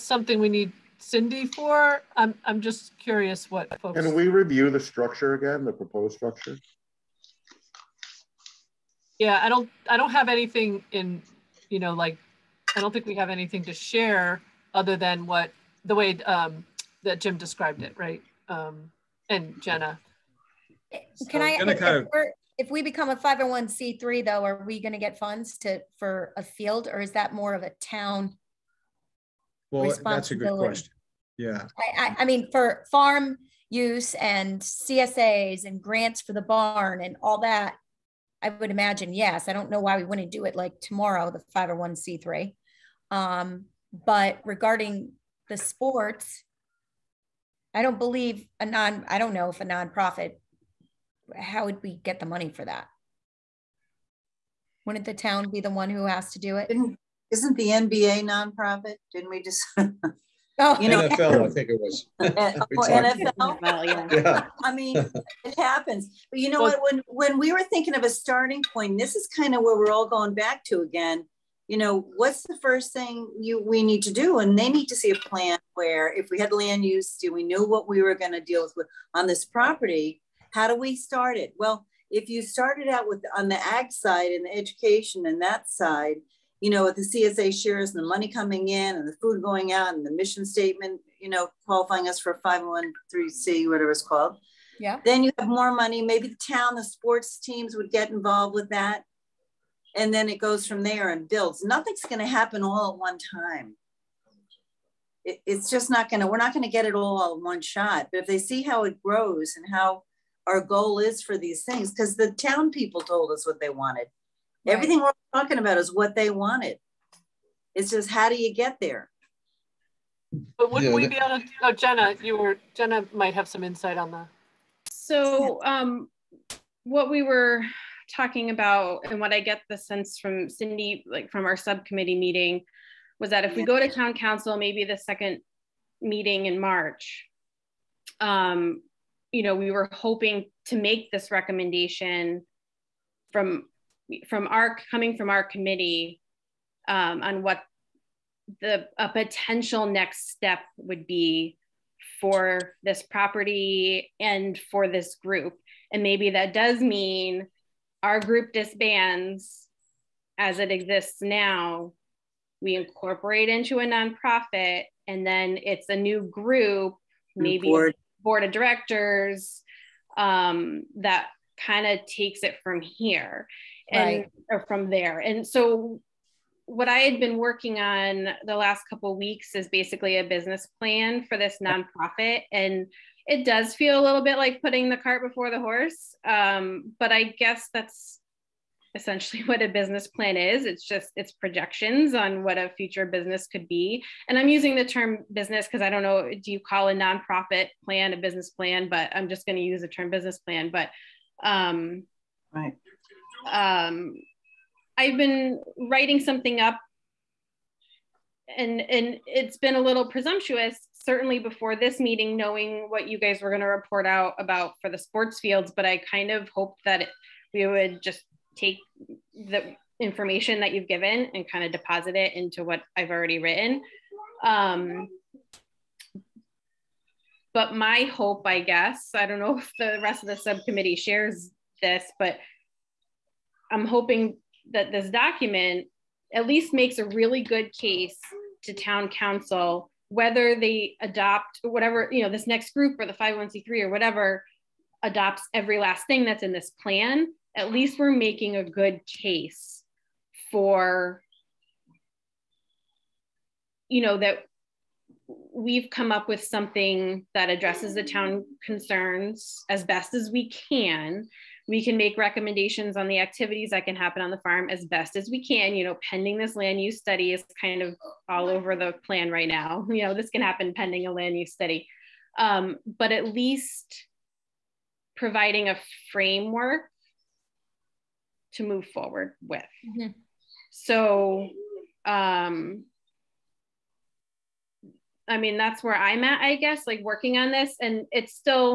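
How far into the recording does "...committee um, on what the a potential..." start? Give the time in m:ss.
2:25.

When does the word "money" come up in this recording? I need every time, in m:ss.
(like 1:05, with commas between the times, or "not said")
0:52, 1:28, 1:35.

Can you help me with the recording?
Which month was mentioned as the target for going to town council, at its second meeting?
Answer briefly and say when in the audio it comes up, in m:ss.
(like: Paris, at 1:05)
March, at 2:16.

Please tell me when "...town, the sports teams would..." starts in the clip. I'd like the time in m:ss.
1:36.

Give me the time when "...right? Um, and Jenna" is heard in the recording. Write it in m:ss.
0:17.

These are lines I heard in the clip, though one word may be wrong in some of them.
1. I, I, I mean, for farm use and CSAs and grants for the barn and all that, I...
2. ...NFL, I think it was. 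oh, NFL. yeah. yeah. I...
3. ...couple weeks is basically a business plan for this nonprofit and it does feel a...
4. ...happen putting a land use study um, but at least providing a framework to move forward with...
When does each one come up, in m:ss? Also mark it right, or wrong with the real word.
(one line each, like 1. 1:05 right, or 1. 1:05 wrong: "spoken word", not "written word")
1. 0:31 right
2. 1:01 right
3. 2:58 right
4. 4:30 wrong: "pending", not "putting".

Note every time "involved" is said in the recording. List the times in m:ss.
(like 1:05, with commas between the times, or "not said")
1:38.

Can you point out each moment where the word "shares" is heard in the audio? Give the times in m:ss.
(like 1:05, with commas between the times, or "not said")
0:13, 1:27, 3:50.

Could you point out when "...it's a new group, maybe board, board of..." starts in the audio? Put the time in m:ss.
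2:45.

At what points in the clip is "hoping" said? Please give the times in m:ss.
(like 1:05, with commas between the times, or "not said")
2:19, 3:53.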